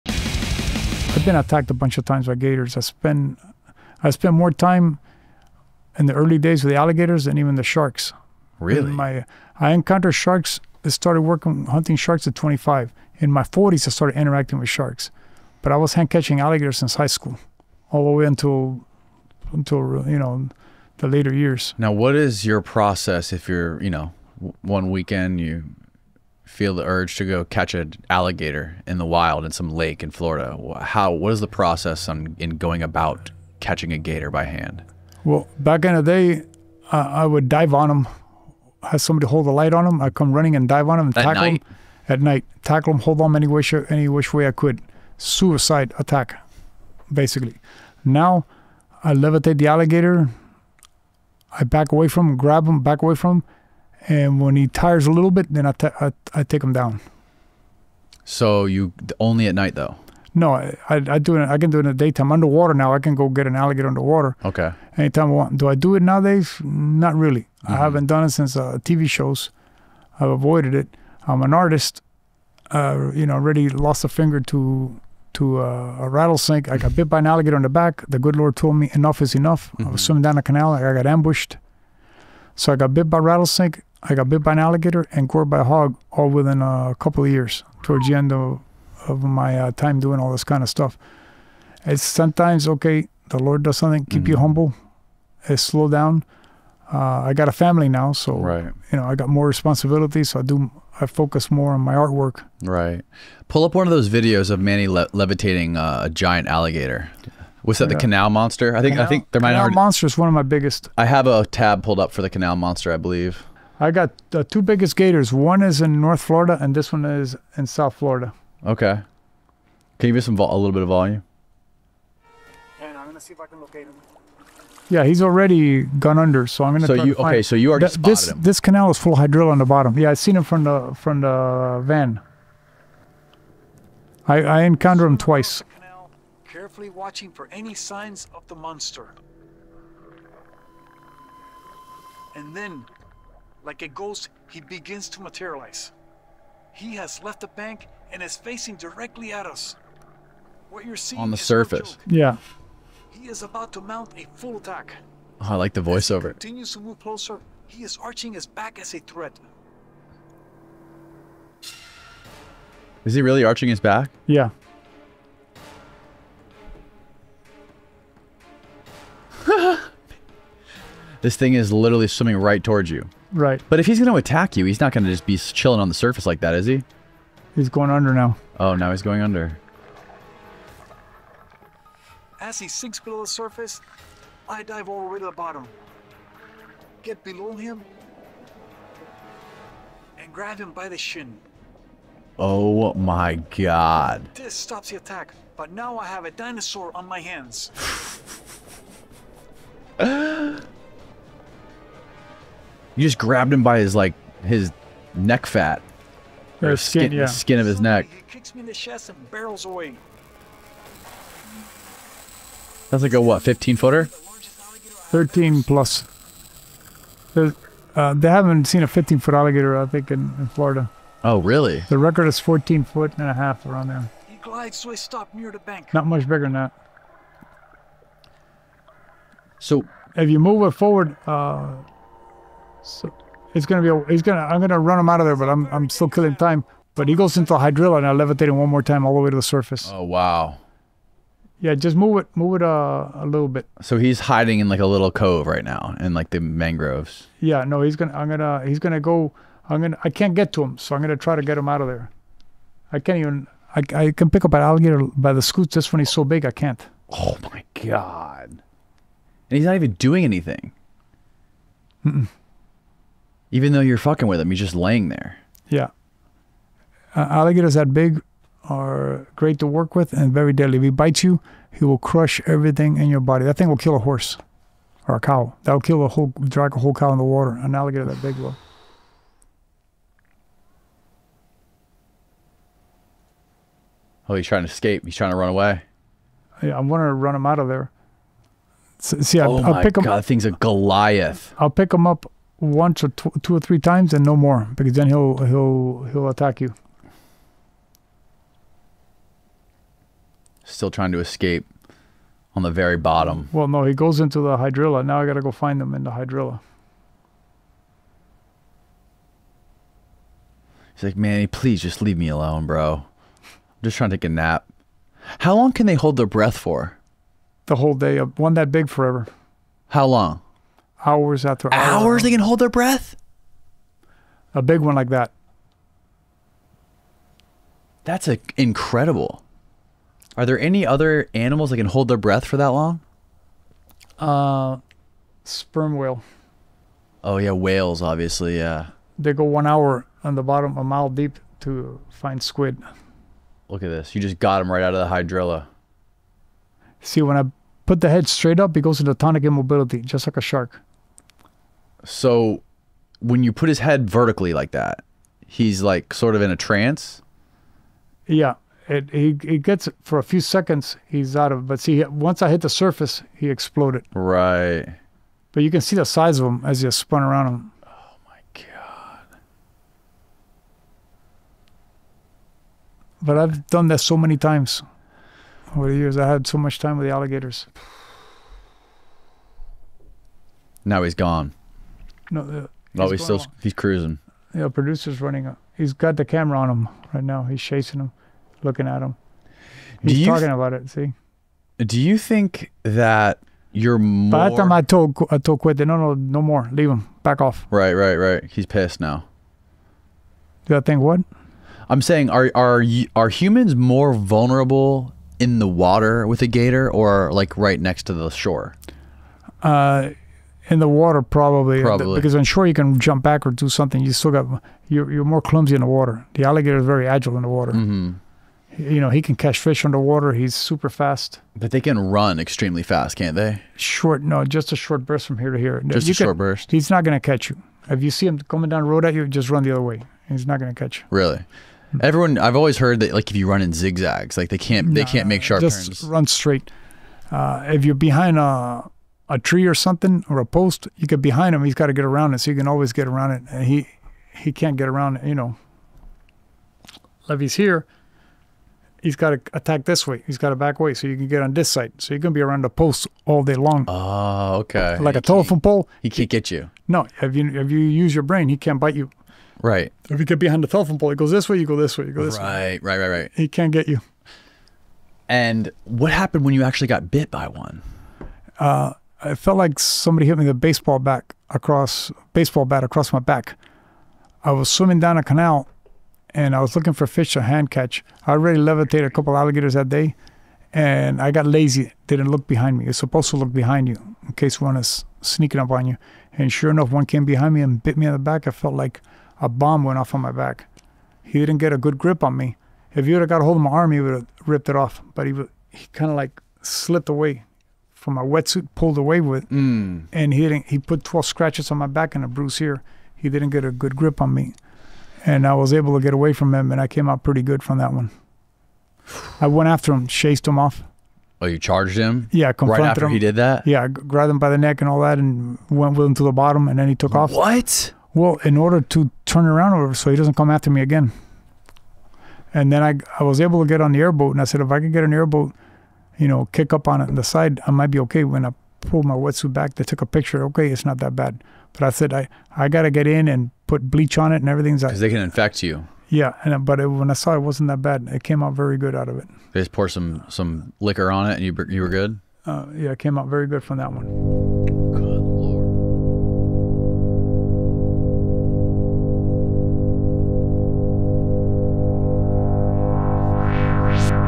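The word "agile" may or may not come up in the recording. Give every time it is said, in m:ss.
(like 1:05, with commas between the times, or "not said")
6:57.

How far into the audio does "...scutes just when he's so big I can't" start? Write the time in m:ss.
4:15.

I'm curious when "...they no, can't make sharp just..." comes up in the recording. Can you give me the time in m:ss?
7:14.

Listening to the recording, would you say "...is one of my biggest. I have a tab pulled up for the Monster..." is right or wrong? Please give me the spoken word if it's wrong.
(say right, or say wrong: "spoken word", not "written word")
wrong: "Canal", not "Monster".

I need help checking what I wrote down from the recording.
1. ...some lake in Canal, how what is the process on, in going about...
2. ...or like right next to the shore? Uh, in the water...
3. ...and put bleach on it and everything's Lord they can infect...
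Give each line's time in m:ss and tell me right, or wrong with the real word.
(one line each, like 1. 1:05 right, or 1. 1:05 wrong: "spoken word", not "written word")
1. 0:29 wrong: "Florida", not "Canal"
2. 6:46 right
3. 8:53 wrong: "Because", not "Lord".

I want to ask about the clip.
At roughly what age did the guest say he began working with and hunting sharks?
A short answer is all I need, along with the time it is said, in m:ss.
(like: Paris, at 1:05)
25, at 0:12.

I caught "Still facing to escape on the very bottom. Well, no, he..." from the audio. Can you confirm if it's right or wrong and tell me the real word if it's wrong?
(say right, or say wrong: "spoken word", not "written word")
wrong: "trying", not "facing".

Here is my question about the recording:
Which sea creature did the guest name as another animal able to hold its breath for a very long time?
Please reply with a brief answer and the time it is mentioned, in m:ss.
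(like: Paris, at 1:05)
sperm whale, at 5:35.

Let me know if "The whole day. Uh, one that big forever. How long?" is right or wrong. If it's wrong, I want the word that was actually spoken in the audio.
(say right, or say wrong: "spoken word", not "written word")
right.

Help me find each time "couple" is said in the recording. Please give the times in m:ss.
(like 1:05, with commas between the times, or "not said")
1:26, 7:59.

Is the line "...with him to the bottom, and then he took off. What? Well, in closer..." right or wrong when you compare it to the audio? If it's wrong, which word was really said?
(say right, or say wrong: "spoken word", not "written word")
wrong: "order", not "closer".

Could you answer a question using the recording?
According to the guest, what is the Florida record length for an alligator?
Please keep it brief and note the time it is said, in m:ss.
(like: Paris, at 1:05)
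14 and a half feet, at 3:42.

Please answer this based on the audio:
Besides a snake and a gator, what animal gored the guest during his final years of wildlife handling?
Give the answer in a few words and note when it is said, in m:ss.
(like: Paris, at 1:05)
hog, at 1:25.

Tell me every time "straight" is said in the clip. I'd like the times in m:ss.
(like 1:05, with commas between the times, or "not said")
5:48, 7:16.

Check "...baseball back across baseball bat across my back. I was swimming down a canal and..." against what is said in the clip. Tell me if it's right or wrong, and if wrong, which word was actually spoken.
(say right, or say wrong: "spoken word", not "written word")
right.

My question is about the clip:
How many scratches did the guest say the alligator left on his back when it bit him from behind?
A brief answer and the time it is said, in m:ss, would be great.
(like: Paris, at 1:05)
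12, at 8:21.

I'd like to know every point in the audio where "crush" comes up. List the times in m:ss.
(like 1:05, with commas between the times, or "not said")
4:31.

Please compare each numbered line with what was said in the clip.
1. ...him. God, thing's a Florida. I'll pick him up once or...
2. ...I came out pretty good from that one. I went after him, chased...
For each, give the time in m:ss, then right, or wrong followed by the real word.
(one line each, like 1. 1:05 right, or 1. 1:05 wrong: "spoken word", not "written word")
1. 4:49 wrong: "Goliath", not "Florida"
2. 8:26 right.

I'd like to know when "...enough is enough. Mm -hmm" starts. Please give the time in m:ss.
1:18.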